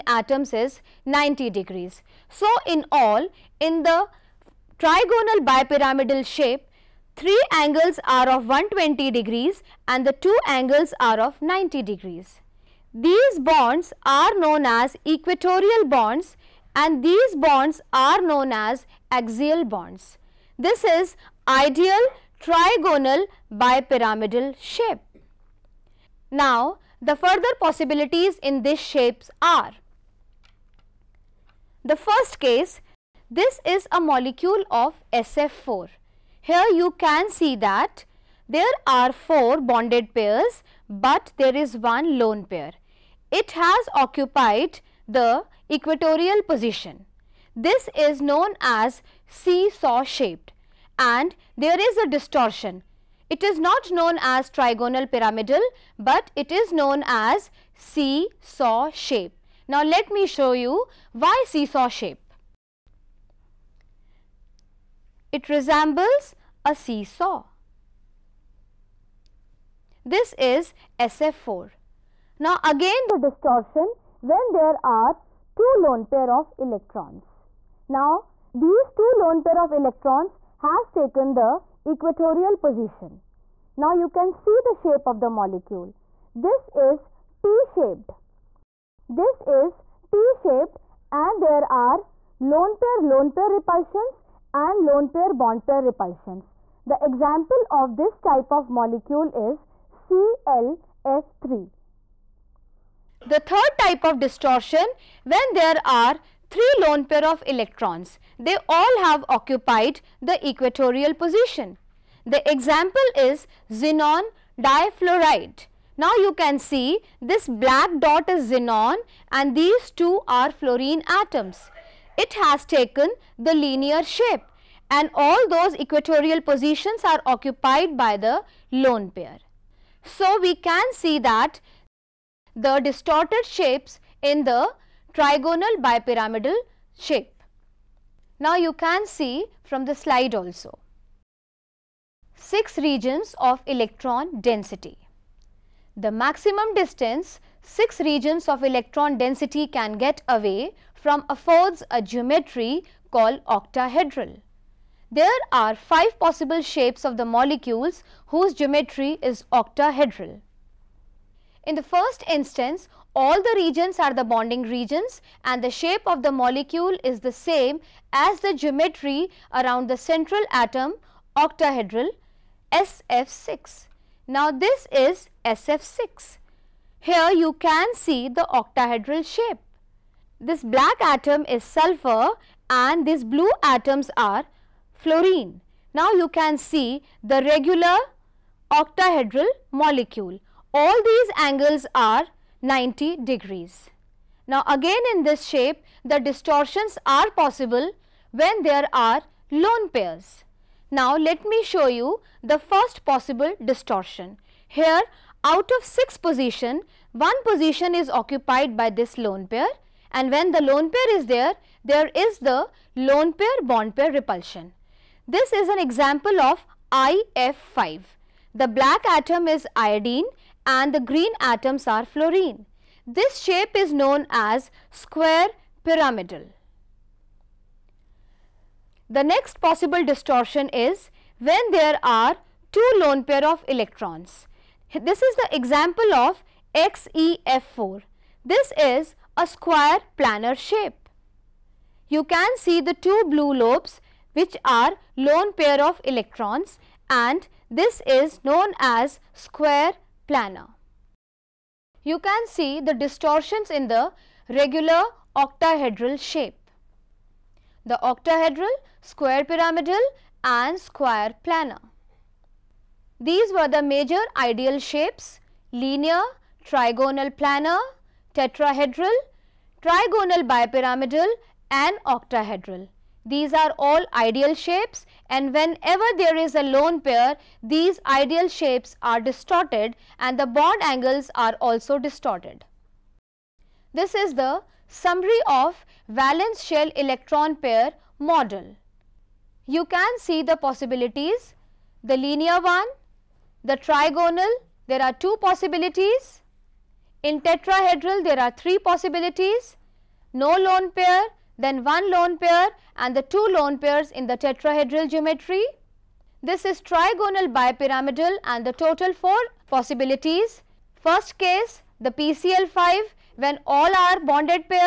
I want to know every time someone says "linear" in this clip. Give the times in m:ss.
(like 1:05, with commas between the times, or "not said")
2:03, 4:25, 4:52.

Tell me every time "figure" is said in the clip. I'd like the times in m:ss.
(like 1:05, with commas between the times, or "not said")
not said.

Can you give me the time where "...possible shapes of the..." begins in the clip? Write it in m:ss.
2:36.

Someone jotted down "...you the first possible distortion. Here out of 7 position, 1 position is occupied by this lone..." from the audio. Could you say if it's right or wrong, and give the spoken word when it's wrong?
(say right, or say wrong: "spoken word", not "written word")
wrong: "6", not "7".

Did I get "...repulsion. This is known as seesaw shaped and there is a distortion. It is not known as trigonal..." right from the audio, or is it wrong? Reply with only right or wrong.
wrong.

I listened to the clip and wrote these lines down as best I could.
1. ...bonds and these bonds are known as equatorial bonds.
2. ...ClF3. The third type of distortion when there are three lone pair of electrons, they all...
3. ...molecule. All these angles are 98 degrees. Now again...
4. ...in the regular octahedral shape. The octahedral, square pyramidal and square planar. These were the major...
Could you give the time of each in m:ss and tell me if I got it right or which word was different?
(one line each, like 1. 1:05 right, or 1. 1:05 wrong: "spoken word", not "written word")
1. 0:15 wrong: "axial", not "equatorial"
2. 1:40 right
3. 3:09 wrong: "90", not "98"
4. 4:13 right.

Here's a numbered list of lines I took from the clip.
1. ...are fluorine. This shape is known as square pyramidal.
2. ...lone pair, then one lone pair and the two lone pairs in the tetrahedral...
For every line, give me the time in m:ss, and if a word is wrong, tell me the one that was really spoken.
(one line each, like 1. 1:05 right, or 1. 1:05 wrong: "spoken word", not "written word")
1. 3:41 right
2. 5:00 right.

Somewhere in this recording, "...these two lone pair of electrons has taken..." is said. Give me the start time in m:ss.
1:18.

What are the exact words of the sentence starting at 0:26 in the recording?
Now, the further possibilities in these shapes are.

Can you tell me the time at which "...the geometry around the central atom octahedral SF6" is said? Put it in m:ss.
2:48.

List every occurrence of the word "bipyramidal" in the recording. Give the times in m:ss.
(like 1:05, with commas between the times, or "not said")
0:05, 0:23, 2:15, 4:30, 5:07.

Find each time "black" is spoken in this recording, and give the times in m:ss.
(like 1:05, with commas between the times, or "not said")
1:57, 3:00, 3:38.